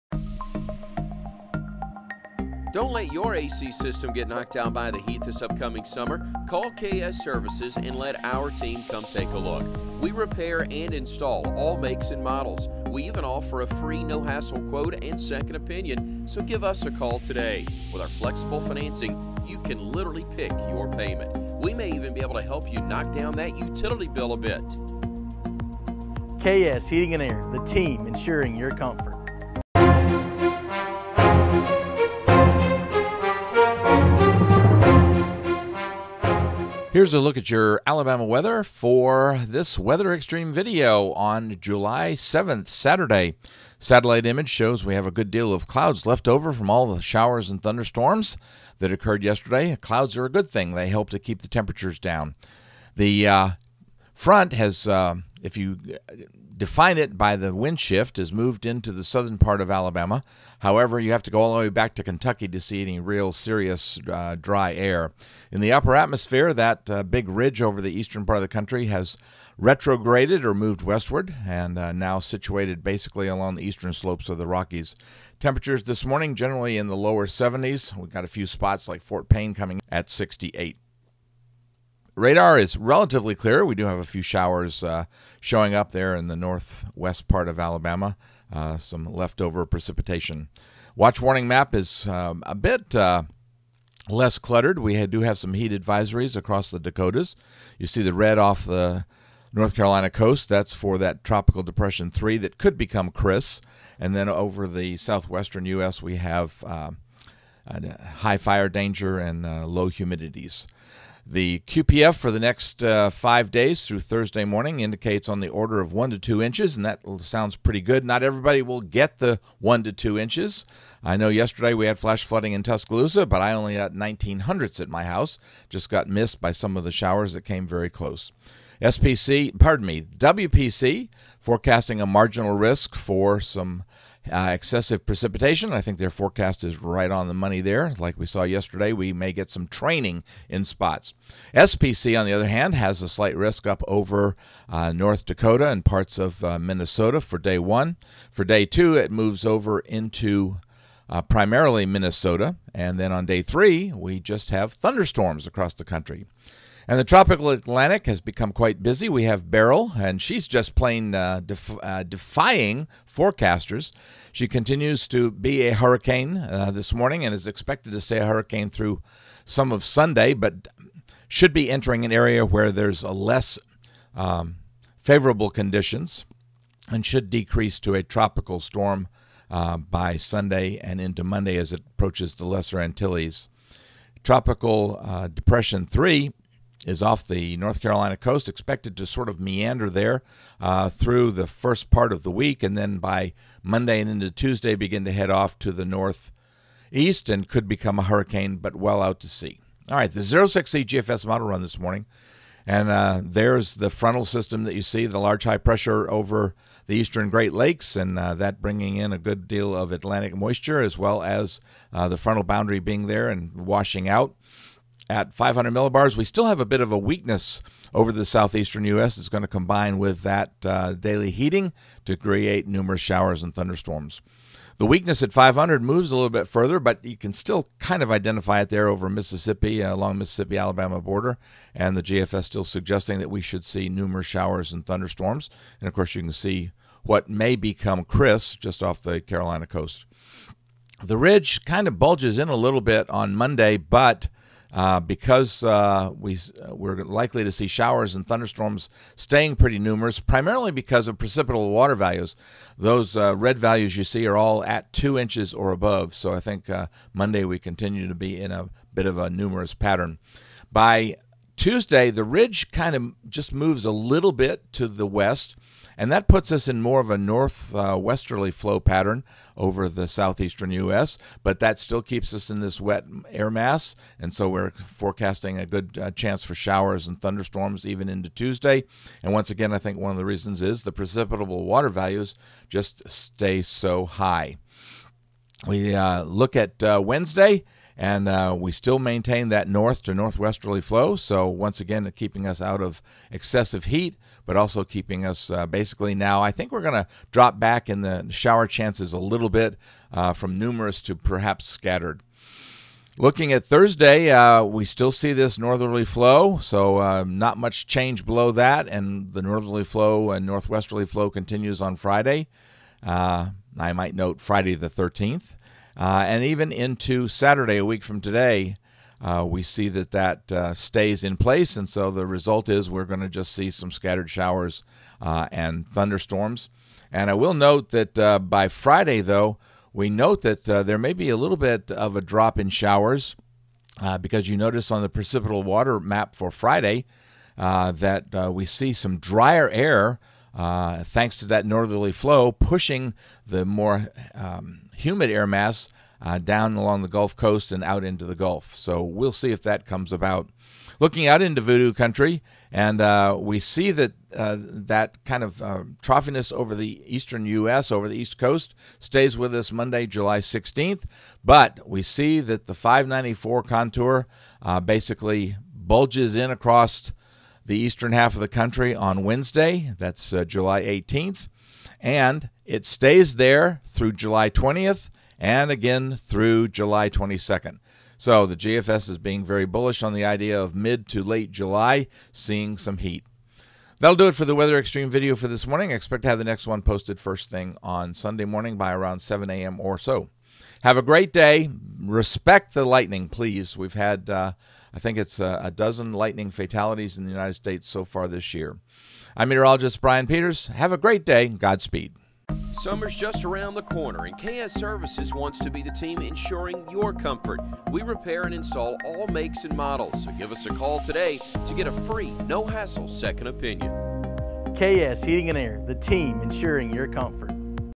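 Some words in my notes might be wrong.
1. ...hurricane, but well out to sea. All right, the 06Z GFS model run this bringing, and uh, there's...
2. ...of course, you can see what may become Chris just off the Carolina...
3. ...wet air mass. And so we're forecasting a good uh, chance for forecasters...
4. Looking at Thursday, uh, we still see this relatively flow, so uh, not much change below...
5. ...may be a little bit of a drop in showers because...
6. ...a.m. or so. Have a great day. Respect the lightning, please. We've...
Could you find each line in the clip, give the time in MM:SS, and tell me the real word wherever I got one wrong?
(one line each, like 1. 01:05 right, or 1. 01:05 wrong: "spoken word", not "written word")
1. 03:18 wrong: "morning", not "bringing"
2. 03:55 right
3. 04:32 wrong: "showers", not "forecasters"
4. 05:03 wrong: "northerly", not "relatively"
5. 05:30 right
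6. 06:29 right.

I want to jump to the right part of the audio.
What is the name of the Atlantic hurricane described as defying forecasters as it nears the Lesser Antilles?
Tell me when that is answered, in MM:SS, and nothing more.
02:39.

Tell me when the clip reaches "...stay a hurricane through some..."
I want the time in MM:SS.
02:48.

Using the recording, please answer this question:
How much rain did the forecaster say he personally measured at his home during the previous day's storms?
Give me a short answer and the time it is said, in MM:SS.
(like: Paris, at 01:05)
19 hundredths, at 02:03.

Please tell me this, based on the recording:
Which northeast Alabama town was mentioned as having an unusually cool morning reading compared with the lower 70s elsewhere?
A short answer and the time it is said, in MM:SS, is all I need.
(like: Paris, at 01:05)
Fort Payne, at 01:19.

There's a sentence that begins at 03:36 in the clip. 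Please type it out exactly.
We still have a bit of a weakness over the southeastern U.S.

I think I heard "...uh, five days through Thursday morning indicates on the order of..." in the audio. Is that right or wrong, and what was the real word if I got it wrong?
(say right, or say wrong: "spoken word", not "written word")
right.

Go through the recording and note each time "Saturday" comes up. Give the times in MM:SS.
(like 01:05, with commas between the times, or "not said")
00:42, 05:17.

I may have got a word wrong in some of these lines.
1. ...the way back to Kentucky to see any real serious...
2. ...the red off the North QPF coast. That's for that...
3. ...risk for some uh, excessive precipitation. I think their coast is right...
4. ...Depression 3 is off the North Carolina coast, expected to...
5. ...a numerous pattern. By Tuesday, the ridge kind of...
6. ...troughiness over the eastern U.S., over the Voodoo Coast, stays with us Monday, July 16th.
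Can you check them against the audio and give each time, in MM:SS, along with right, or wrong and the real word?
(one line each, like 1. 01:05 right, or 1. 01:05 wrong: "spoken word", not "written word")
1. 01:01 right
2. 01:38 wrong: "Carolina", not "QPF"
3. 02:12 wrong: "forecast", not "coast"
4. 03:05 right
5. 04:19 right
6. 05:56 wrong: "East", not "Voodoo".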